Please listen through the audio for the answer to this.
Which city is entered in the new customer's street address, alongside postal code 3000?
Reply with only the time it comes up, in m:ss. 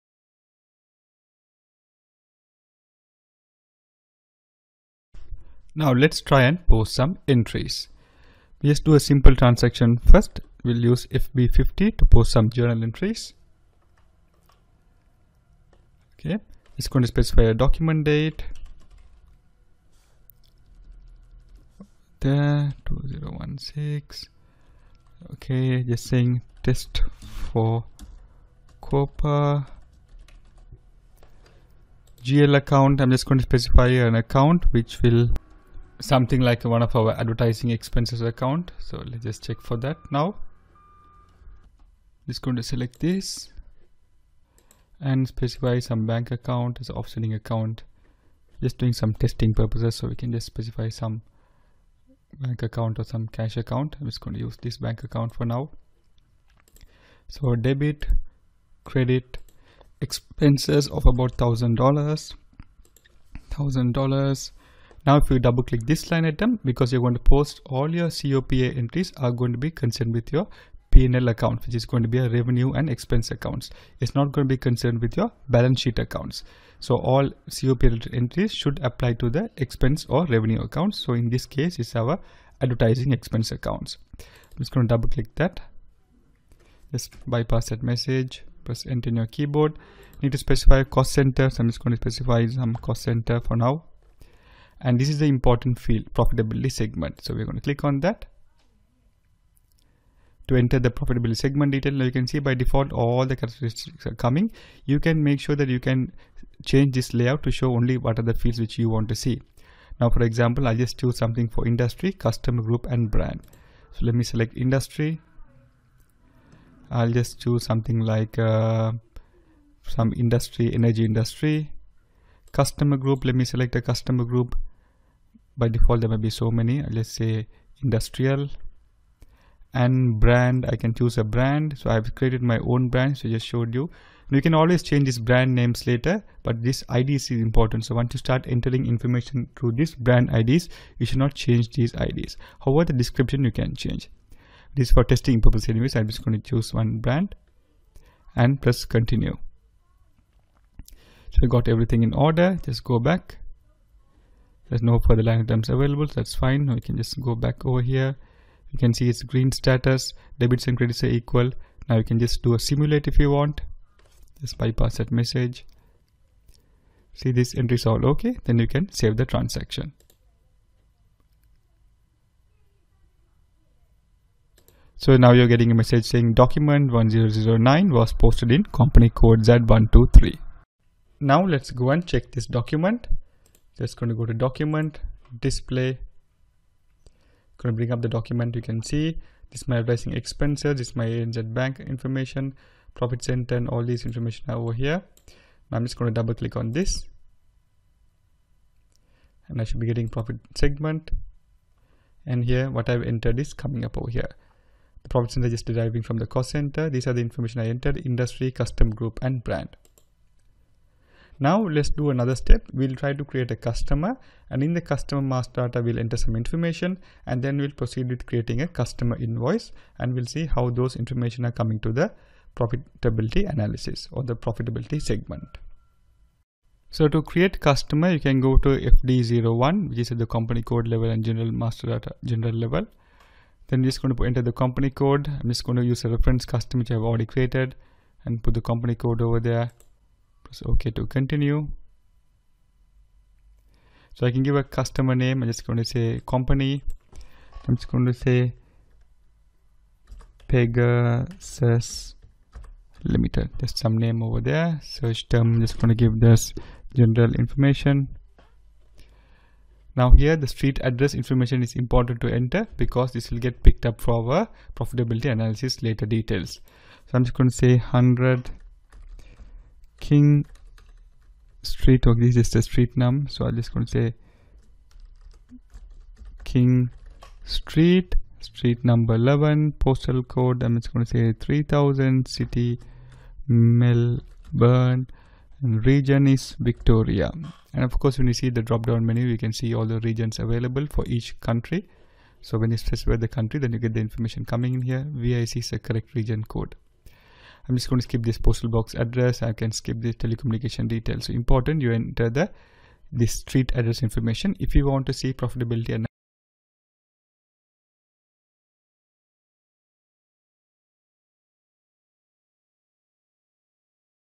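4:43.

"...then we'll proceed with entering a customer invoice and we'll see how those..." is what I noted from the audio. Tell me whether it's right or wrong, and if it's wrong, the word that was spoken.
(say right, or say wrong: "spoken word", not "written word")
wrong: "creating", not "entering".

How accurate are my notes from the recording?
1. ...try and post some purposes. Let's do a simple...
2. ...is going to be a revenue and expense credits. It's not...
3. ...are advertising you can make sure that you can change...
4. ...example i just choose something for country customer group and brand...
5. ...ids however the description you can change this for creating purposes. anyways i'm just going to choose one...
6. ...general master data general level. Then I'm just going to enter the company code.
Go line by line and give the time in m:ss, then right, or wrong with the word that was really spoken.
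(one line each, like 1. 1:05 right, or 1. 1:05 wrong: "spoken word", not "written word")
1. 0:06 wrong: "entries", not "purposes"
2. 1:11 wrong: "accounts", not "credits"
3. 1:44 wrong: "coming", not "advertising"
4. 1:50 wrong: "industry", not "country"
5. 2:21 wrong: "testing", not "creating"
6. 3:51 right.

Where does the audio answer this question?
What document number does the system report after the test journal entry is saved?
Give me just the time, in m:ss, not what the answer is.
2:56.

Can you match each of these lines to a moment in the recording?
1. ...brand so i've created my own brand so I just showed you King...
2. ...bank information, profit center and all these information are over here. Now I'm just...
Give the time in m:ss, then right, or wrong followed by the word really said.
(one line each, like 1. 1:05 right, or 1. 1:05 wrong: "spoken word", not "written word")
1. 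2:11 wrong: "Now", not "King"
2. 3:11 right.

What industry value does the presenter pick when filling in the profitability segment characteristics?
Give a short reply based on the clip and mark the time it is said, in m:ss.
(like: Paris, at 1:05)
Energy, at 2:00.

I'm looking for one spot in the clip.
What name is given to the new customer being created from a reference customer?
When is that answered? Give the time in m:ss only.
4:10.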